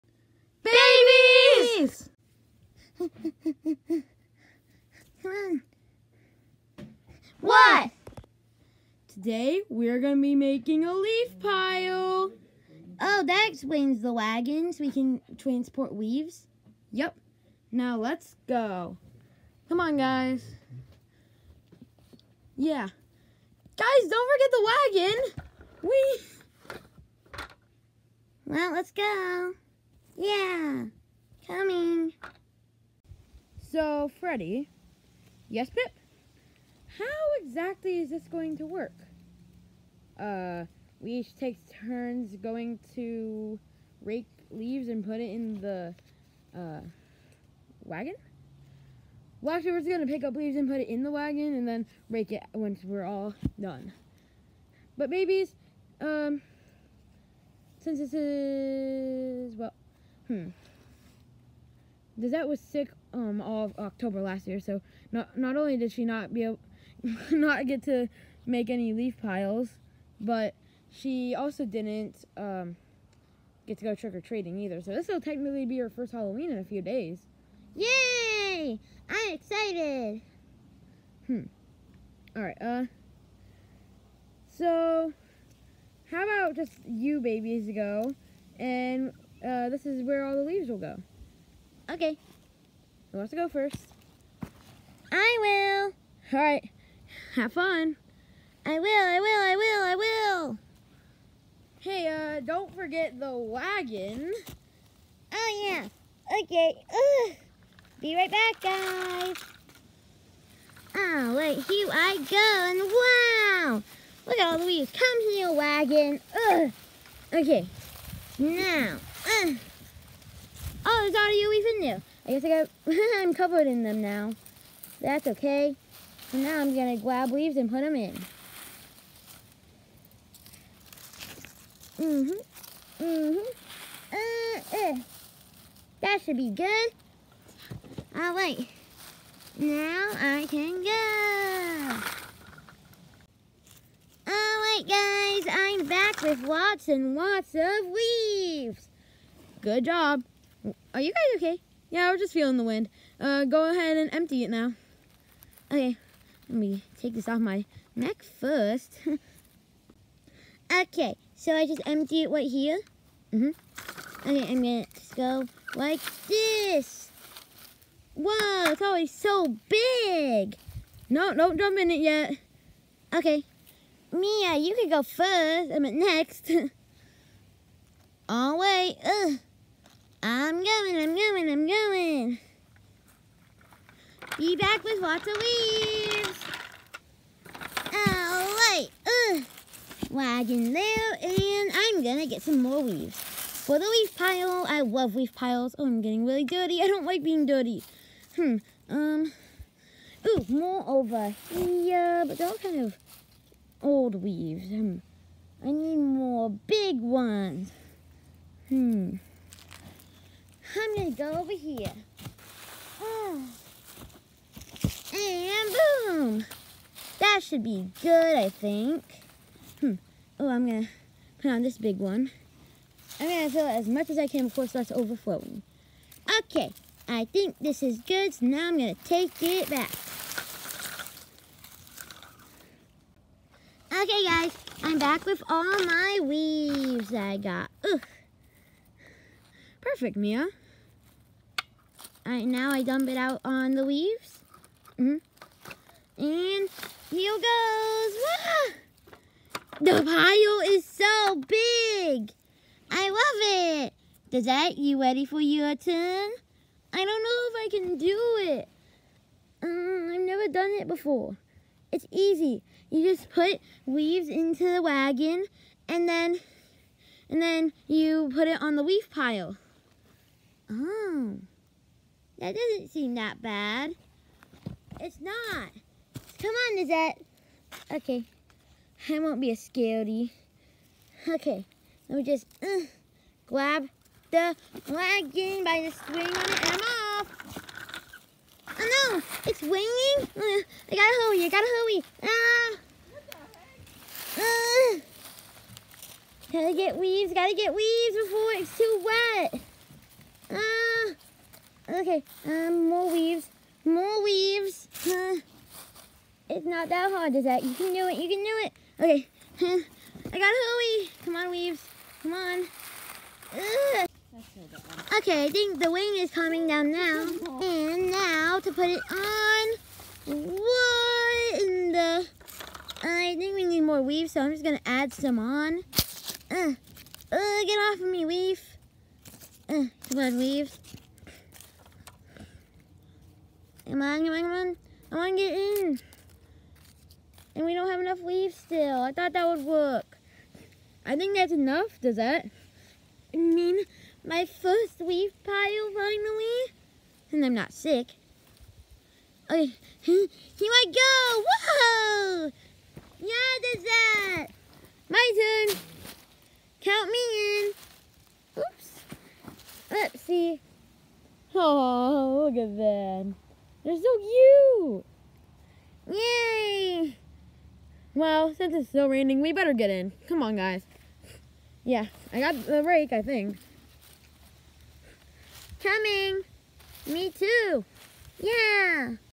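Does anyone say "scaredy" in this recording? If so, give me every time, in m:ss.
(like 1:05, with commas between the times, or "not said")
4:39.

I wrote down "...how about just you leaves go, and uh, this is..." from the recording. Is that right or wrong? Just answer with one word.
wrong.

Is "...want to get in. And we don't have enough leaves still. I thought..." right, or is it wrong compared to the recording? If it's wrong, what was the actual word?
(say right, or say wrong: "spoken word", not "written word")
right.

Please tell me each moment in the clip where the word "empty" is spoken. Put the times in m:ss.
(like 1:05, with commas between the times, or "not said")
2:34, 2:41.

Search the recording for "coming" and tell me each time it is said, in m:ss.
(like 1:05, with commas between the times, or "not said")
0:31, 5:16, 6:15.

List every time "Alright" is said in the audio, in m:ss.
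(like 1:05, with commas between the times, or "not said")
1:22, 3:08.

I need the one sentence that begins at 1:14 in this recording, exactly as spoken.
So this will technically be her first Halloween in a few days.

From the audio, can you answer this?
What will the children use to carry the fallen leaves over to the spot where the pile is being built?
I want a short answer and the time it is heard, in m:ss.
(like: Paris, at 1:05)
Wagons, at 0:14.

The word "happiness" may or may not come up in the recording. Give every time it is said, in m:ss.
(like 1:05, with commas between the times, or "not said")
not said.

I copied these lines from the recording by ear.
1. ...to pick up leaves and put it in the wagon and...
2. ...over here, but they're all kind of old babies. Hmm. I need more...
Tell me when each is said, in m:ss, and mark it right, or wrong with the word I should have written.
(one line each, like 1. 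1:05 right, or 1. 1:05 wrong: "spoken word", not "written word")
1. 0:50 right
2. 3:20 wrong: "leaves", not "babies".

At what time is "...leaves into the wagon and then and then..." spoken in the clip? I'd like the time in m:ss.
4:23.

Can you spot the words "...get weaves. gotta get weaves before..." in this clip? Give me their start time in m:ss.
4:56.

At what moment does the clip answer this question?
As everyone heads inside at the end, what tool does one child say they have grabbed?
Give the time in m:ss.
6:12.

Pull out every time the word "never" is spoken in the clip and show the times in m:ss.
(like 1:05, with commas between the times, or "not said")
4:20.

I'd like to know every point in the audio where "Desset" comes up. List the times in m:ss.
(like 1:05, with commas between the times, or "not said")
1:02, 4:14, 4:36, 5:53.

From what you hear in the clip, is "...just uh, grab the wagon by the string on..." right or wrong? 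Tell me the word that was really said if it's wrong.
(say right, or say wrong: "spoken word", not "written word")
right.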